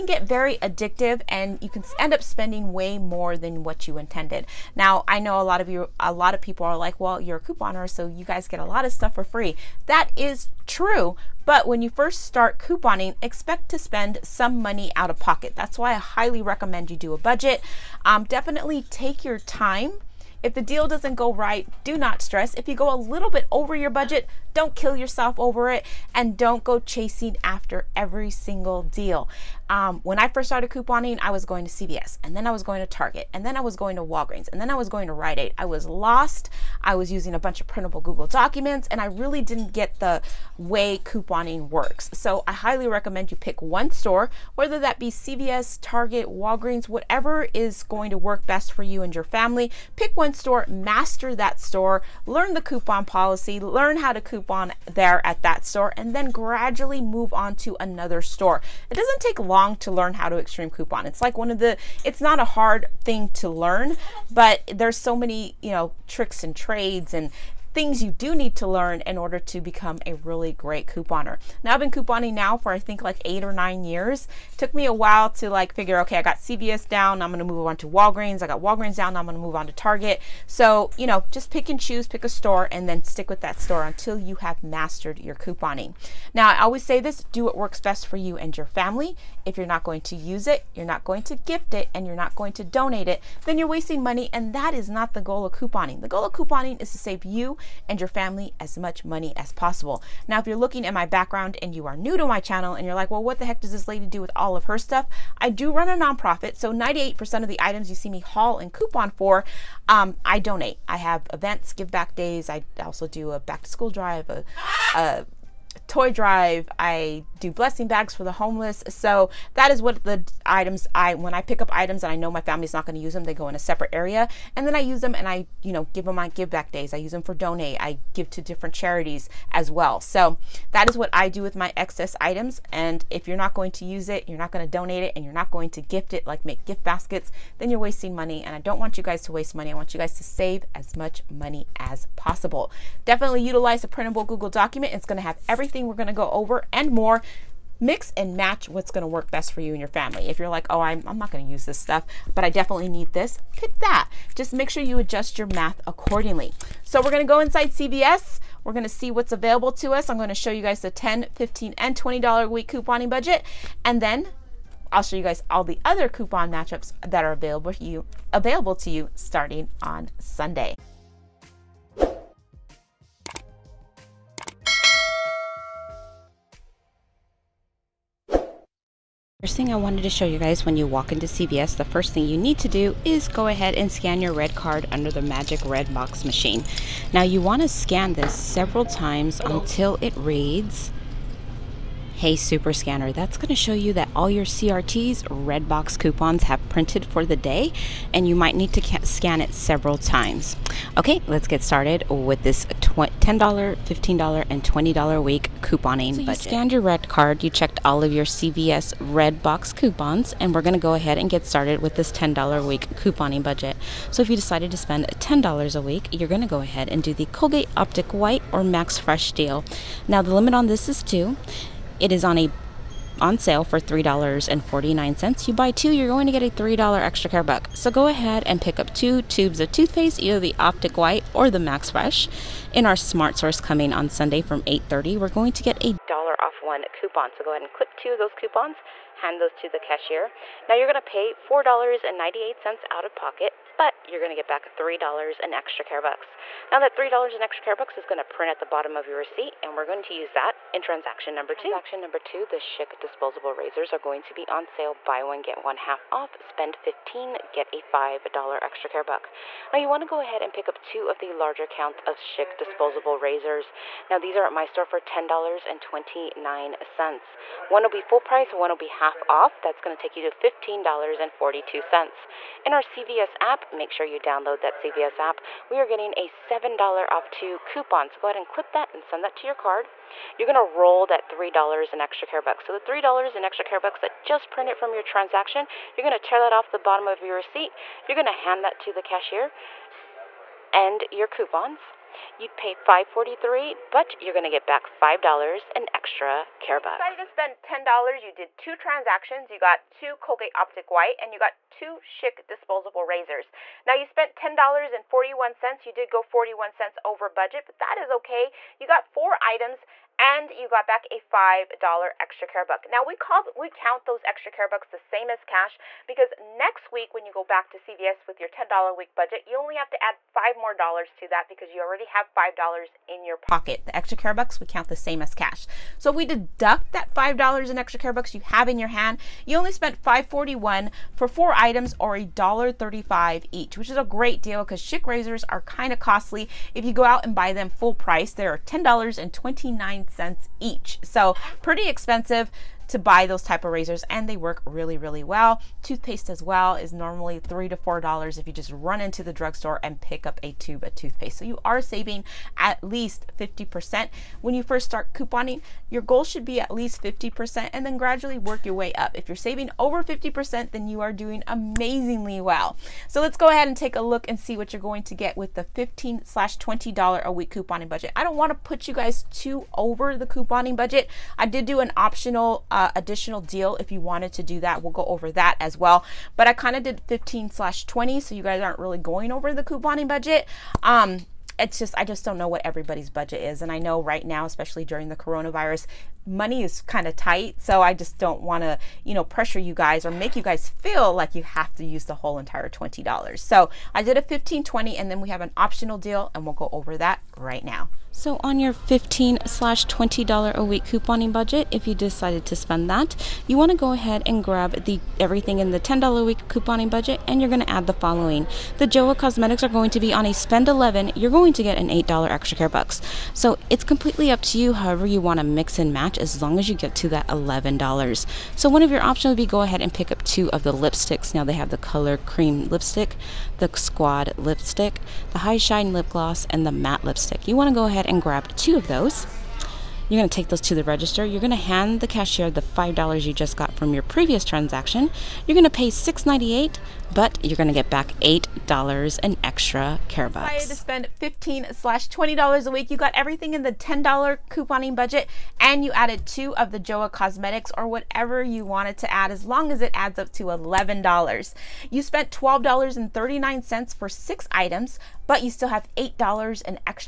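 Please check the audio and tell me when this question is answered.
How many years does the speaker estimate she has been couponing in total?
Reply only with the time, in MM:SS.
01:13.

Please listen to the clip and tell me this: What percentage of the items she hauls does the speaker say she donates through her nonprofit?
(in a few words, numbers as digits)
98%.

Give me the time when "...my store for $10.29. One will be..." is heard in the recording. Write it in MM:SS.
04:24.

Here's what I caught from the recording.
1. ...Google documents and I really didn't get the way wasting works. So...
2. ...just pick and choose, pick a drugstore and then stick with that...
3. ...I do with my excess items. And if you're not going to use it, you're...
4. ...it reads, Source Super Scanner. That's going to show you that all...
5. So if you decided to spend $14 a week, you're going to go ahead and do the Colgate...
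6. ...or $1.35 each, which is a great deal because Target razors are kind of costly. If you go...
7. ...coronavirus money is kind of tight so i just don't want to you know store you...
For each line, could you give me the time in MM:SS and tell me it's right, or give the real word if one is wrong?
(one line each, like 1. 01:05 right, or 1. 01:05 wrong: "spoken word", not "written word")
1. 00:38 wrong: "couponing", not "wasting"
2. 01:21 wrong: "store", not "drugstore"
3. 02:11 right
4. 03:09 wrong: "Hey", not "Source"
5. 03:34 wrong: "10", not "14"
6. 05:31 wrong: "Schick", not "Target"
7. 06:25 wrong: "pressure", not "store".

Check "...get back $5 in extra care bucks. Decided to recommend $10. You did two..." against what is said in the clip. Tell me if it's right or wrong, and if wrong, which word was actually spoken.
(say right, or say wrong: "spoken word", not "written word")
wrong: "spend", not "recommend".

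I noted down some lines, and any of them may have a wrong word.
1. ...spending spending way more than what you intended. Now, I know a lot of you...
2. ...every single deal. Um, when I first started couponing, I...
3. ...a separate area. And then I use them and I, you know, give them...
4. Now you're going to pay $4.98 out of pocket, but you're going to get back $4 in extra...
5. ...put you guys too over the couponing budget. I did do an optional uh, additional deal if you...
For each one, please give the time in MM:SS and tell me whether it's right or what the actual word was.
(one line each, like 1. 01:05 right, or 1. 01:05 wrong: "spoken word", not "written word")
1. 00:02 right
2. 00:27 right
3. 02:03 right
4. 04:00 wrong: "3", not "4"
5. 06:08 right.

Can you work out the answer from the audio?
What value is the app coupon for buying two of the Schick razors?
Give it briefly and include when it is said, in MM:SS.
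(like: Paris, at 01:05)
$7 off 2, at 04:36.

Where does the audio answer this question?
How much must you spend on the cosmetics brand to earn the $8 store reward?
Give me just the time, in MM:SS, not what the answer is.
06:50.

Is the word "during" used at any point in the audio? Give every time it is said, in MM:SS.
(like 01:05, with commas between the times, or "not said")
06:24.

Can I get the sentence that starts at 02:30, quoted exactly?
If you're like, oh, I'm, I'm not going to use this stuff, but I definitely need this, pick that.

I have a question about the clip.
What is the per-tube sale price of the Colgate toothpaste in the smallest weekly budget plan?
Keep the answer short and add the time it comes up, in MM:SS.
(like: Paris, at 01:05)
$3.49, at 03:43.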